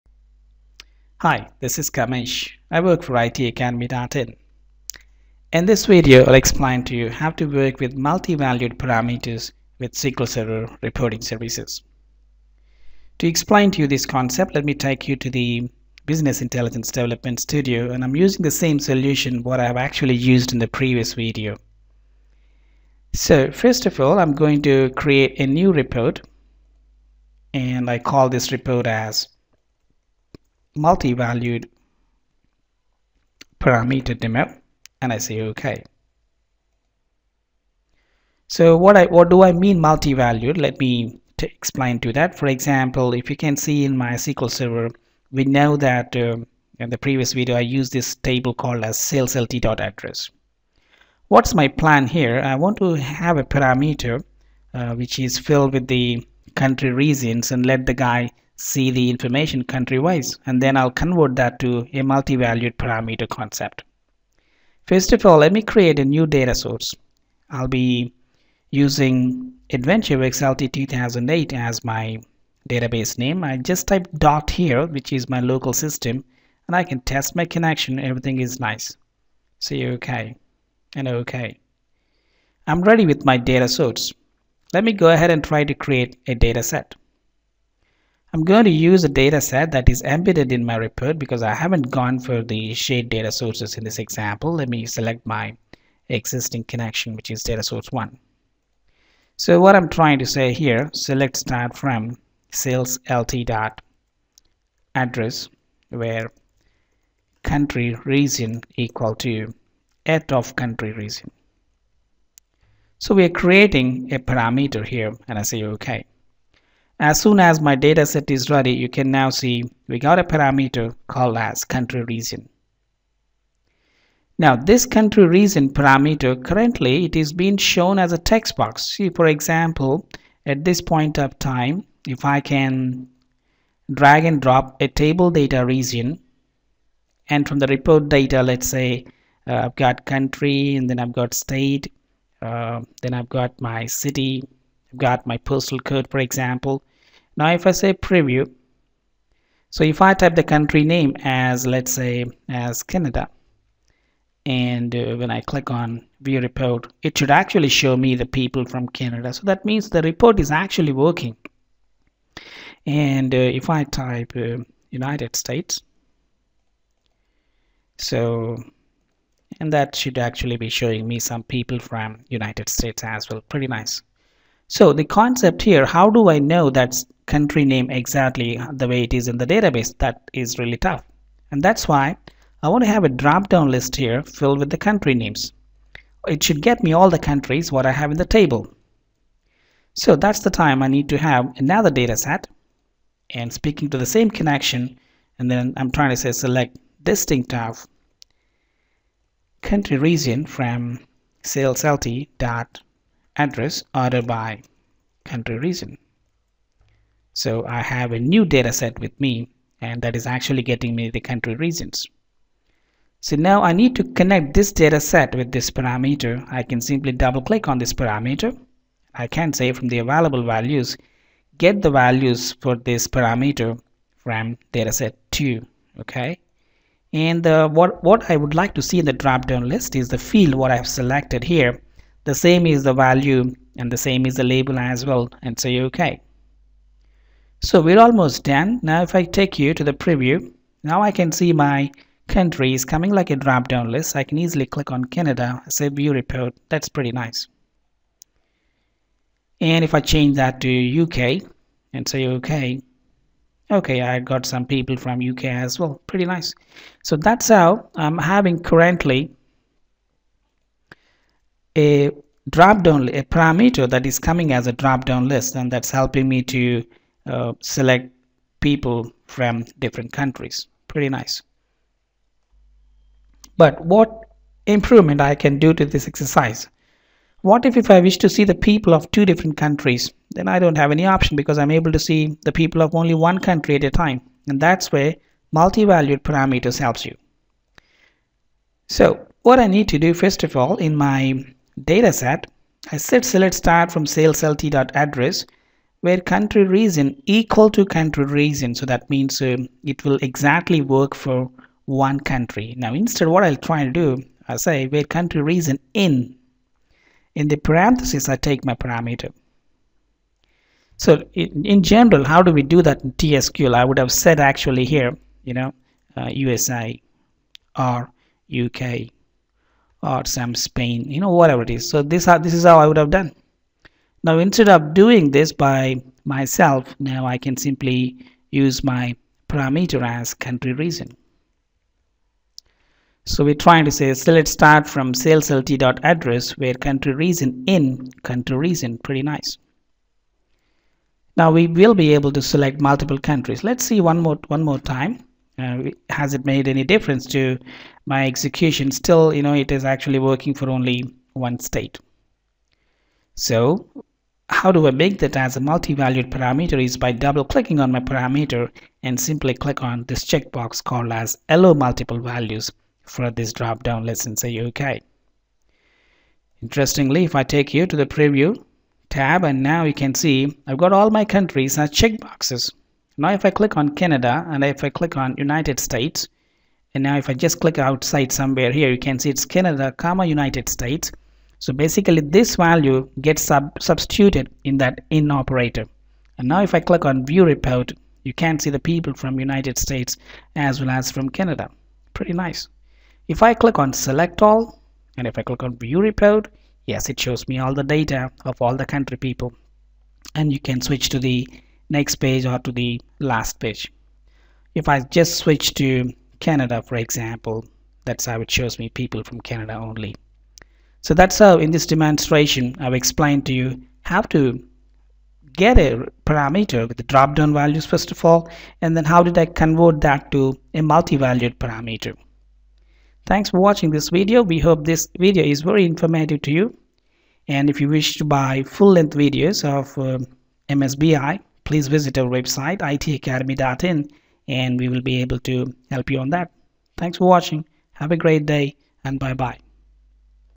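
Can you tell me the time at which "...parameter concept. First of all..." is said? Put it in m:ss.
1:02.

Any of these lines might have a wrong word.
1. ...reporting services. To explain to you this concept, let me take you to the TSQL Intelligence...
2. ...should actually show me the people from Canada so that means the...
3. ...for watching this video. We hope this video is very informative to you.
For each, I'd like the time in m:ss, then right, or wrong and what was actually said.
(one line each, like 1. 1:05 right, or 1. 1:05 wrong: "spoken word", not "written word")
1. 0:10 wrong: "Business", not "TSQL"
2. 2:37 right
3. 7:03 right.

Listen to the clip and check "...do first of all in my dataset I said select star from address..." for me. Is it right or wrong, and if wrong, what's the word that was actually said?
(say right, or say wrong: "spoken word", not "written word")
right.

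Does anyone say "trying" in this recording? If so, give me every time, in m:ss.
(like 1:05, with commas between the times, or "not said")
1:39, 3:15, 5:33.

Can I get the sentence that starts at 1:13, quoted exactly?
I just type dot here, which is my local system, and I can test my connection.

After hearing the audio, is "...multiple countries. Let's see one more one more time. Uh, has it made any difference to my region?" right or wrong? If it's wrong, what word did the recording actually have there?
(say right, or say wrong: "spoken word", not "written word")
wrong: "execution", not "region".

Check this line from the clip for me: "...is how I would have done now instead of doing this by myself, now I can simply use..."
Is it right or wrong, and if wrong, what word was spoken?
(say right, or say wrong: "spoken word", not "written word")
right.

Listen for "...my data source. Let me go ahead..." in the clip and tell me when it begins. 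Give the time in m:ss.
1:23.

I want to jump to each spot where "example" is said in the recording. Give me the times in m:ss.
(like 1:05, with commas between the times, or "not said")
0:42, 1:33, 2:09, 2:26, 6:46.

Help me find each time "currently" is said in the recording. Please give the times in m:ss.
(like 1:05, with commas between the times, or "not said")
2:06, 4:18.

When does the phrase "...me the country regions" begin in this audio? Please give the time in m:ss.
3:30.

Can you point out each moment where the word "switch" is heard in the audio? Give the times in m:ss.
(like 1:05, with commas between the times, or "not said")
6:40, 6:45.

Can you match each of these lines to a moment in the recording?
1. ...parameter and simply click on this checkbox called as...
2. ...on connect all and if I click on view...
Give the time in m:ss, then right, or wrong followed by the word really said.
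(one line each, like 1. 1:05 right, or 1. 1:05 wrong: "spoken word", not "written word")
1. 5:58 right
2. 6:33 wrong: "select", not "connect".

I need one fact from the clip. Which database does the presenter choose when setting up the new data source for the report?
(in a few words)
Adventure LT 2008.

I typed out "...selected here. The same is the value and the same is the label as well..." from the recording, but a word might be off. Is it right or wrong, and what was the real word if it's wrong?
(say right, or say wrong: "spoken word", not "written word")
right.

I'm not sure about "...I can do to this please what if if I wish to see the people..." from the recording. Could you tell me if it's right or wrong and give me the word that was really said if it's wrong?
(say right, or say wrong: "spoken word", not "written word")
wrong: "exercise", not "please".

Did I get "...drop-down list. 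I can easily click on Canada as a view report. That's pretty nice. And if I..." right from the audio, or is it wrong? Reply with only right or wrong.
right.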